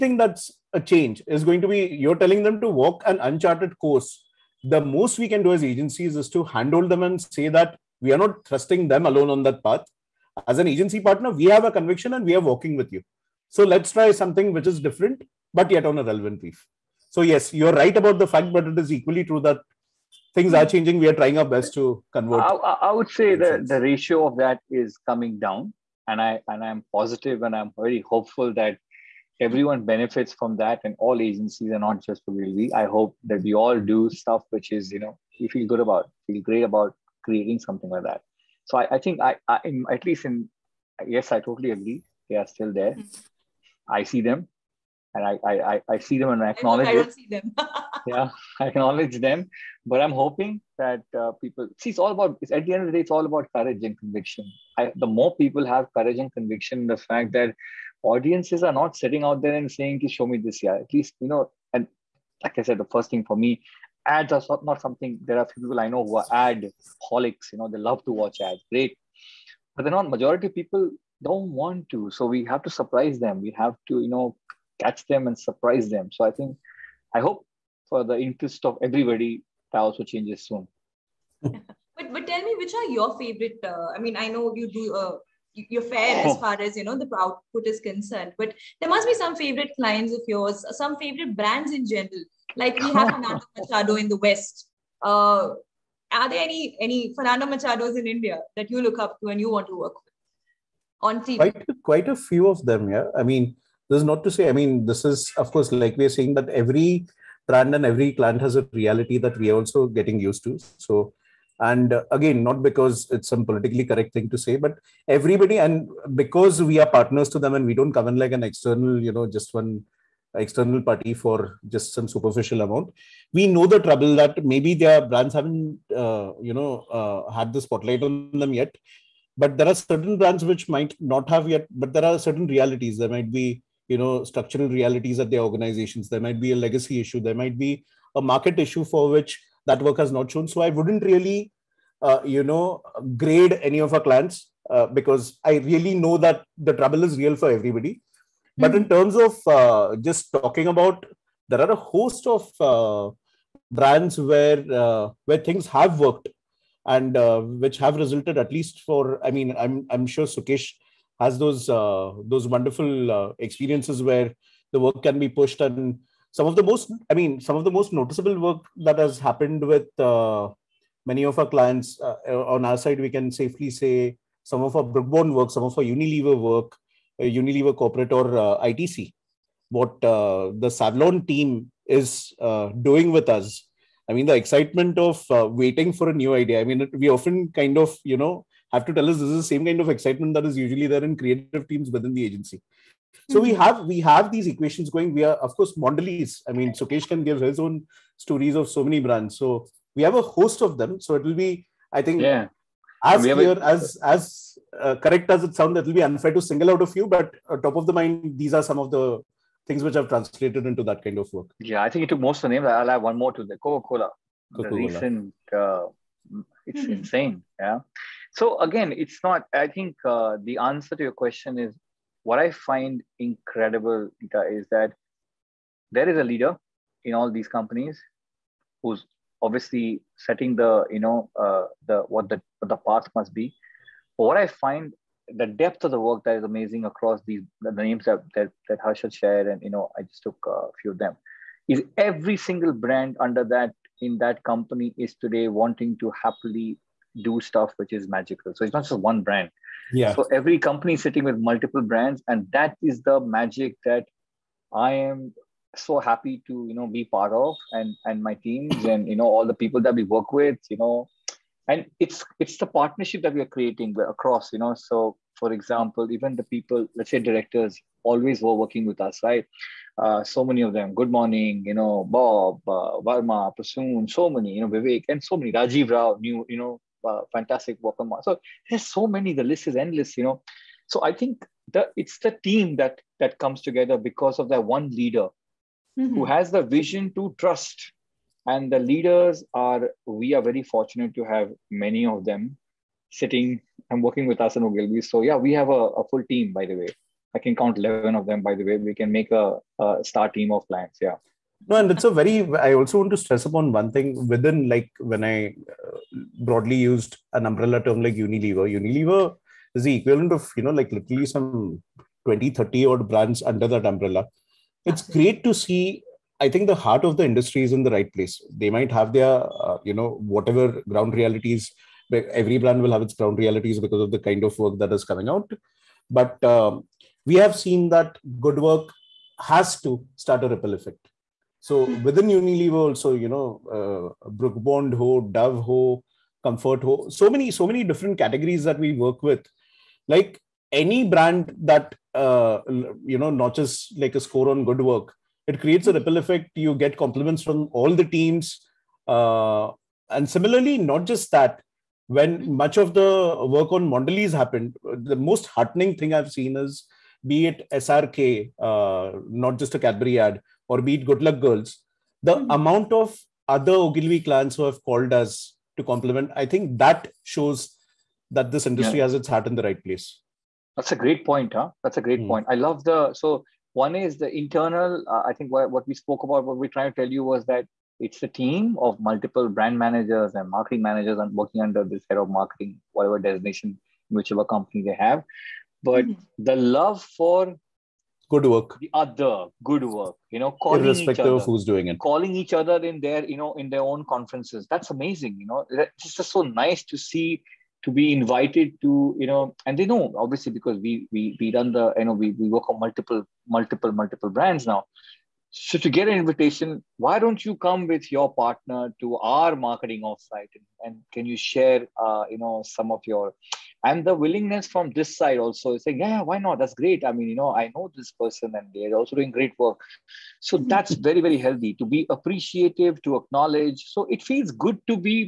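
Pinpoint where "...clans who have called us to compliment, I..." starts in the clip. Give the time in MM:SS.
06:04.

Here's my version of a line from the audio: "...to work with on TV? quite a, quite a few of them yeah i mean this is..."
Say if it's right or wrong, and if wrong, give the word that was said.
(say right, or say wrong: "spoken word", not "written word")
right.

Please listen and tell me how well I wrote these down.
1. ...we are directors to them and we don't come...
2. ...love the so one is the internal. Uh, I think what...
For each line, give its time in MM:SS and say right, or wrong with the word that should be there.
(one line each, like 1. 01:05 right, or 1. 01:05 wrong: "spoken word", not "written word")
1. 01:56 wrong: "partners", not "directors"
2. 06:12 right.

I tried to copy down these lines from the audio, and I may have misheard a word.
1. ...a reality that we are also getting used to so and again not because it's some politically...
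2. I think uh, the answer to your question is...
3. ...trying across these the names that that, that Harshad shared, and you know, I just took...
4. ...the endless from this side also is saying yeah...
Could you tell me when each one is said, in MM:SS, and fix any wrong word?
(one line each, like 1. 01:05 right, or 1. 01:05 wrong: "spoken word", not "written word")
1. 01:48 right
2. 03:39 right
3. 03:56 wrong: "amazing", not "trying"
4. 06:54 wrong: "willingness", not "endless".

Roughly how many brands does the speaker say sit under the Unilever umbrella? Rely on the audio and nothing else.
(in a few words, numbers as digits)
20 to 30.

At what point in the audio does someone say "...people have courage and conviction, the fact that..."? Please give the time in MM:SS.
00:55.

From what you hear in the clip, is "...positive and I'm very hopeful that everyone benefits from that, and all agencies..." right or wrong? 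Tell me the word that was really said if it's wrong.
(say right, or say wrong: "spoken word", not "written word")
right.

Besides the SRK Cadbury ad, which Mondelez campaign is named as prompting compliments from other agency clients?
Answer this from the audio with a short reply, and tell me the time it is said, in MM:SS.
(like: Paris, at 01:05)
Good Luck Girls, at 06:01.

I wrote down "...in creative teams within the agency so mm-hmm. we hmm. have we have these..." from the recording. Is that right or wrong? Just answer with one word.
right.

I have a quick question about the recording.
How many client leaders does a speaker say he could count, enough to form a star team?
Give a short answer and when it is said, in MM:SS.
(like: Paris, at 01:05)
11, at 04:57.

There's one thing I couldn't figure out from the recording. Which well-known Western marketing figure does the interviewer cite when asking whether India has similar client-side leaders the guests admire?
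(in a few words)
Fernando Machado.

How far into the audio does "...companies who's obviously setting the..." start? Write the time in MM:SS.
03:47.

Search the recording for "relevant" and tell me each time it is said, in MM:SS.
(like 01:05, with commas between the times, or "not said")
00:16.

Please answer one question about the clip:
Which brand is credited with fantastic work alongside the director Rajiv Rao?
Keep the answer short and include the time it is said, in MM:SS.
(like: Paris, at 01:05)
Moss, at 04:38.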